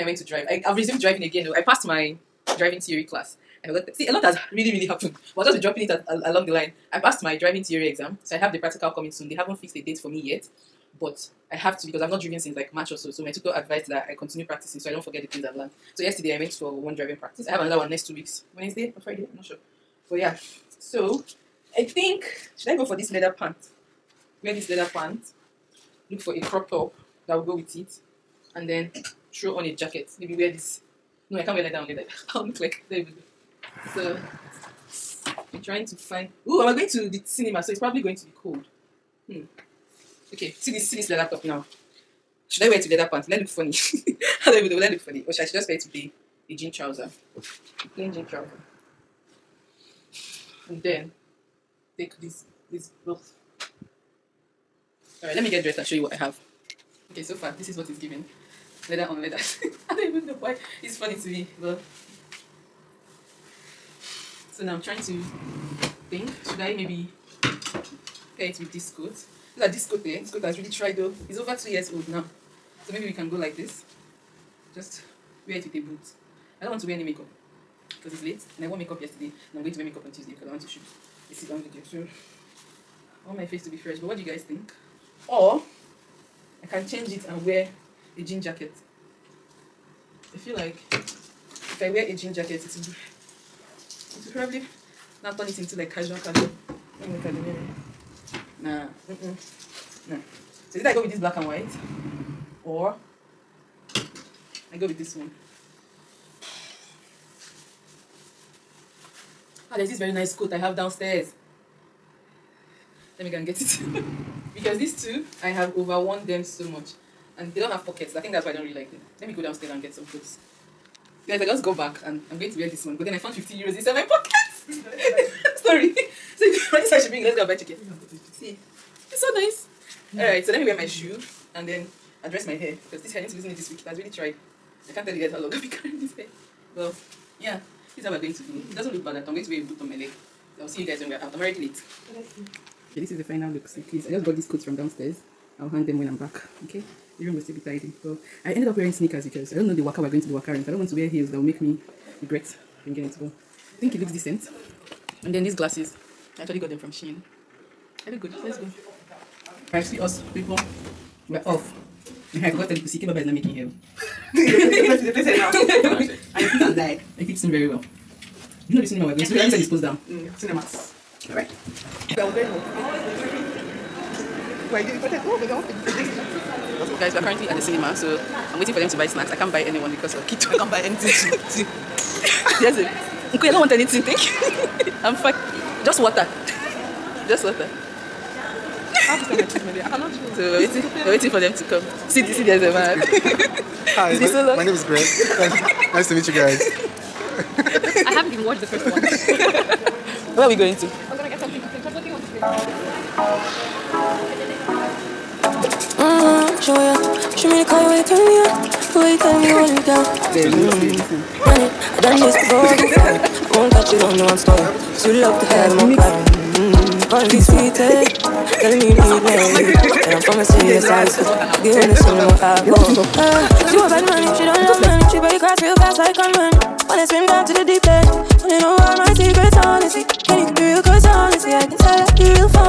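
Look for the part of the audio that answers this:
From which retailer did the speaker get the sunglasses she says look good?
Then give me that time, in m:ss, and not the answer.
2:36.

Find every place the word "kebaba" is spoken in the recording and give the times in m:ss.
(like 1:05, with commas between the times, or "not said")
2:42.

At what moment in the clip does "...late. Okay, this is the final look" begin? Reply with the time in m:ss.
2:21.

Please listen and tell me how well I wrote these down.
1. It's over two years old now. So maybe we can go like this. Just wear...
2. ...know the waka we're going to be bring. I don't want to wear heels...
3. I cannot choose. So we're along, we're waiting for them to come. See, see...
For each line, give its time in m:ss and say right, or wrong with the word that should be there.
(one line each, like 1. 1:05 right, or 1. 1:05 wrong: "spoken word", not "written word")
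1. 1:11 right
2. 2:29 wrong: "wakaring", not "bring"
3. 3:09 wrong: "waiting", not "along".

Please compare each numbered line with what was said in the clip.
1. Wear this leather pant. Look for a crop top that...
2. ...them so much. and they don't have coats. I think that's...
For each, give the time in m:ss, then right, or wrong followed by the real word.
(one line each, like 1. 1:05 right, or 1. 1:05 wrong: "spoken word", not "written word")
1. 0:24 right
2. 1:56 wrong: "pockets", not "coats".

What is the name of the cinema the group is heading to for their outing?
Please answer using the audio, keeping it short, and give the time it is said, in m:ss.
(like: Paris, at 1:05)
Cinemax, at 2:50.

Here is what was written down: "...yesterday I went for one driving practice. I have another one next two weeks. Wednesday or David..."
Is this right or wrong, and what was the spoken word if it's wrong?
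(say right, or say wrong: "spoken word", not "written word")
wrong: "Friday", not "David".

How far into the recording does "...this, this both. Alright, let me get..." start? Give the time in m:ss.
0:52.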